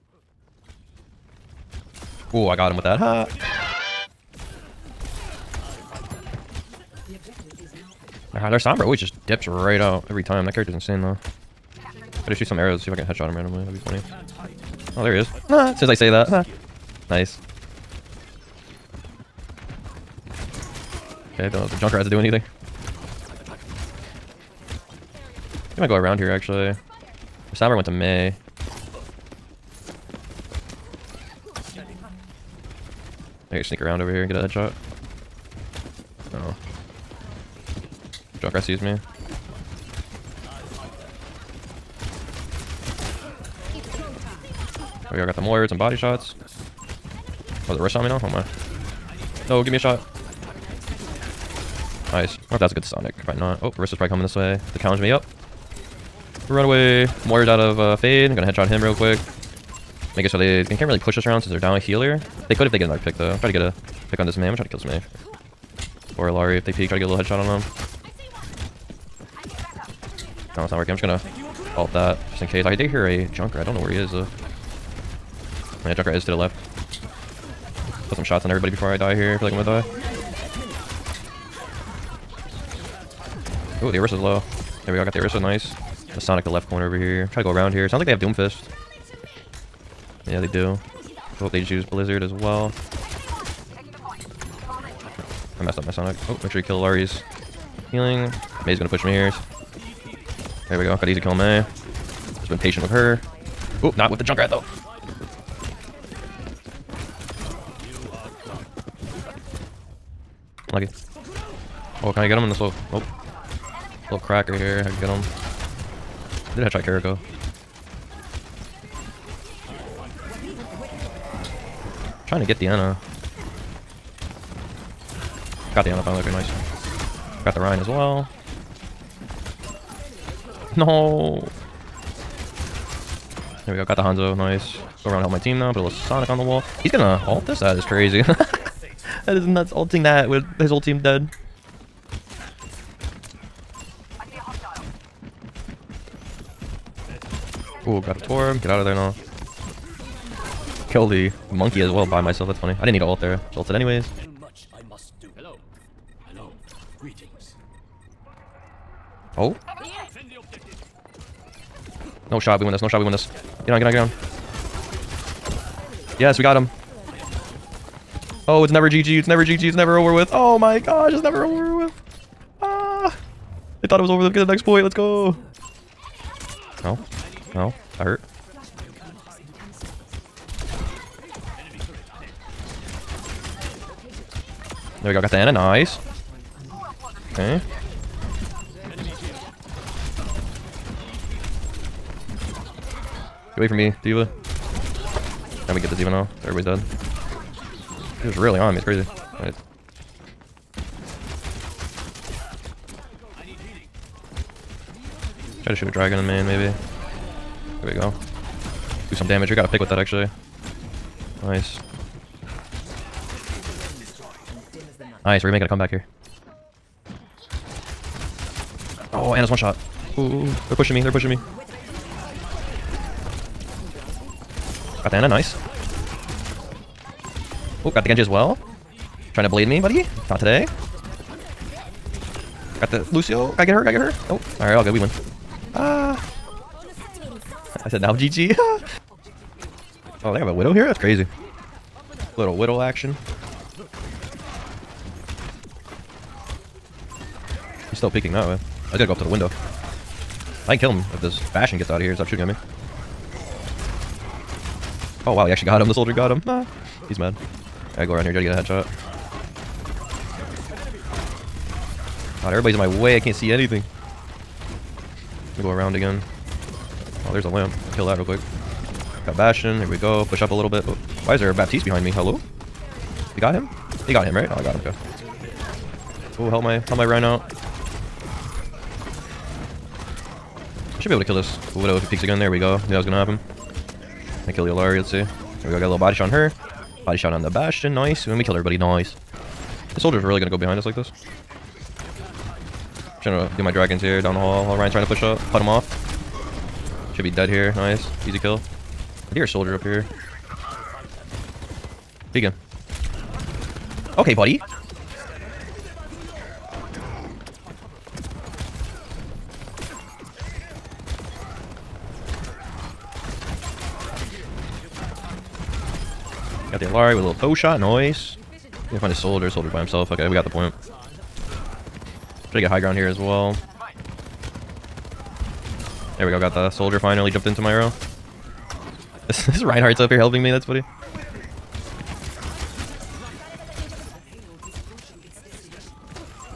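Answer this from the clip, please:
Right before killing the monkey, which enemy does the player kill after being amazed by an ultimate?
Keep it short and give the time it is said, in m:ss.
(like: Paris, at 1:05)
Torb, at 2:28.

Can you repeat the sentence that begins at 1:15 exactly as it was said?
Yeah, Junker is to the left.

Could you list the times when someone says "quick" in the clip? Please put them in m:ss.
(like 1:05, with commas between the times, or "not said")
0:58, 4:28.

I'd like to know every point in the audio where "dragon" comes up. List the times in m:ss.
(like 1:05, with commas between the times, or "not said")
3:25, 4:53.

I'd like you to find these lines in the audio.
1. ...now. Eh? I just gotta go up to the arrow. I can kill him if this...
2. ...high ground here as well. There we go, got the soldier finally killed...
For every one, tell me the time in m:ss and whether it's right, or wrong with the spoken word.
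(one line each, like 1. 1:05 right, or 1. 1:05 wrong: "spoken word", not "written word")
1. 4:08 wrong: "window", not "arrow"
2. 5:22 wrong: "jumped", not "killed".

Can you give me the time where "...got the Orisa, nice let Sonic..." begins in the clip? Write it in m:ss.
1:25.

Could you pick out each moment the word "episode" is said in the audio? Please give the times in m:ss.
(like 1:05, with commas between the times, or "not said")
not said.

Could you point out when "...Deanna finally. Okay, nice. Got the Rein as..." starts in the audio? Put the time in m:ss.
2:05.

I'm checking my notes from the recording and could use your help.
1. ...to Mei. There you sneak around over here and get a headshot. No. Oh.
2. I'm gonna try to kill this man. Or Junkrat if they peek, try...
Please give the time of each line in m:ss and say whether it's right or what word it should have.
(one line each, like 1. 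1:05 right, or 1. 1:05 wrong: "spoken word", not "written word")
1. 0:27 right
2. 1:04 wrong: "Illari", not "Junkrat".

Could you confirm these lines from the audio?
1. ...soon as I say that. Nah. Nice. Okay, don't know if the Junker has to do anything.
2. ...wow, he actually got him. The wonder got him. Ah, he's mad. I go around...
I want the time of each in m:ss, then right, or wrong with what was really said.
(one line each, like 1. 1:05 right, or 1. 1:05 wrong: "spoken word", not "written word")
1. 0:15 right
2. 4:15 wrong: "soldier", not "wonder".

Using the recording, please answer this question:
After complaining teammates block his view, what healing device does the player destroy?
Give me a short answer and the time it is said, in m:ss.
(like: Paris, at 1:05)
lamp, at 4:27.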